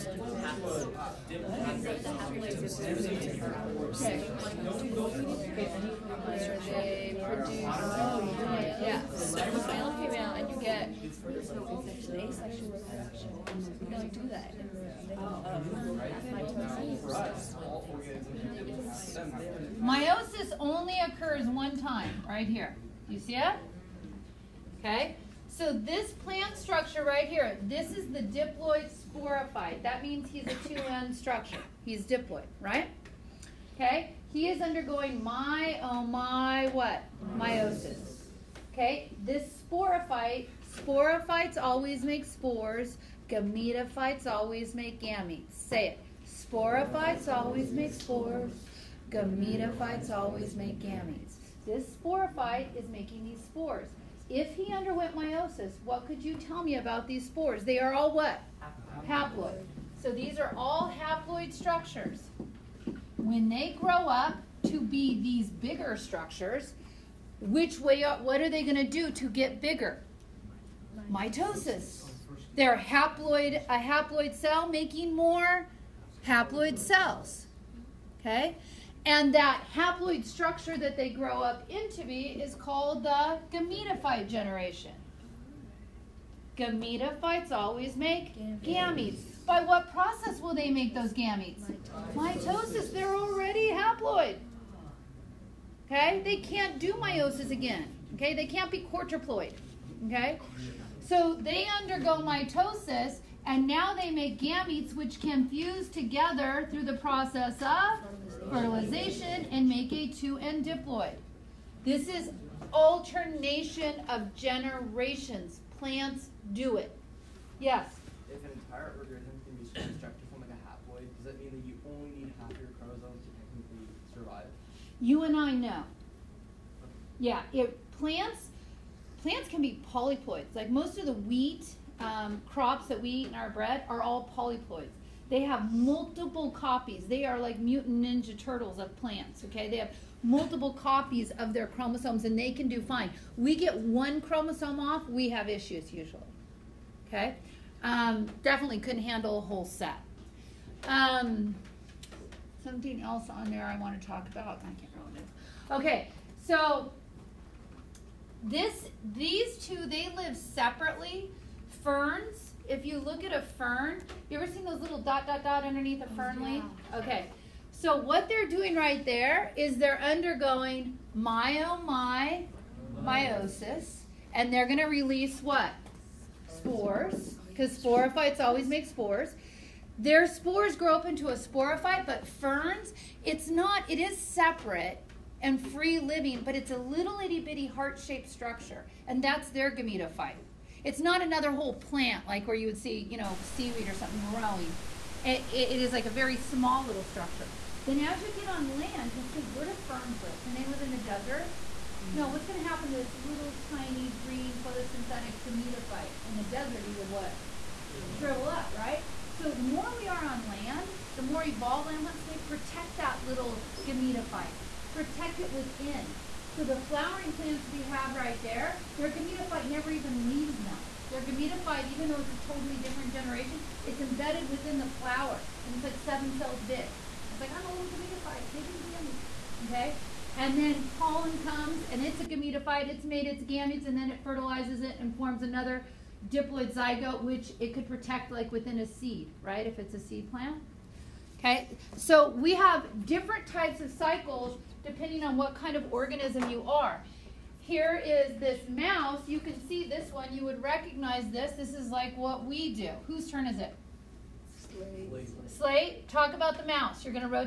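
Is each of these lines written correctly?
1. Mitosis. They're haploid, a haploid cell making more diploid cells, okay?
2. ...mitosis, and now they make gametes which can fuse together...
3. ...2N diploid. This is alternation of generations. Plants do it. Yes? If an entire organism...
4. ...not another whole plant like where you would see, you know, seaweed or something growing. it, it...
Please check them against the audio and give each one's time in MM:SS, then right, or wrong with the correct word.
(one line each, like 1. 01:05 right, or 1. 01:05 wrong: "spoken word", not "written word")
1. 01:11 wrong: "haploid", not "diploid"
2. 01:42 right
3. 01:50 right
4. 03:10 right.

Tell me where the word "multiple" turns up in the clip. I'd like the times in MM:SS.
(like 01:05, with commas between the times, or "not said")
02:15, 02:20.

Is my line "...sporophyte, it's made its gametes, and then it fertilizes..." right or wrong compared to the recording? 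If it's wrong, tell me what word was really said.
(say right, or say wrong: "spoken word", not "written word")
wrong: "gametophyte", not "sporophyte".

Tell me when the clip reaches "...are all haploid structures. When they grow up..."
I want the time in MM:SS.
01:00.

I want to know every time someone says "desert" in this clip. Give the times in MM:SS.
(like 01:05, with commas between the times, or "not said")
03:20, 03:26.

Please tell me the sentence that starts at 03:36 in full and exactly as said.
So the flowering plants we have right there, their gametophyte never even leaves them.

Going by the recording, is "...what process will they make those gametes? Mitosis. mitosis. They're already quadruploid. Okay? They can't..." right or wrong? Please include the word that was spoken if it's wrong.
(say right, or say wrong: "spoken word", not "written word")
wrong: "haploid", not "quadruploid".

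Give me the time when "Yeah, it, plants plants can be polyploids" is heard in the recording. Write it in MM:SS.
02:07.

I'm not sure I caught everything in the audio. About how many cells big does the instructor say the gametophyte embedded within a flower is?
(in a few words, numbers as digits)
7.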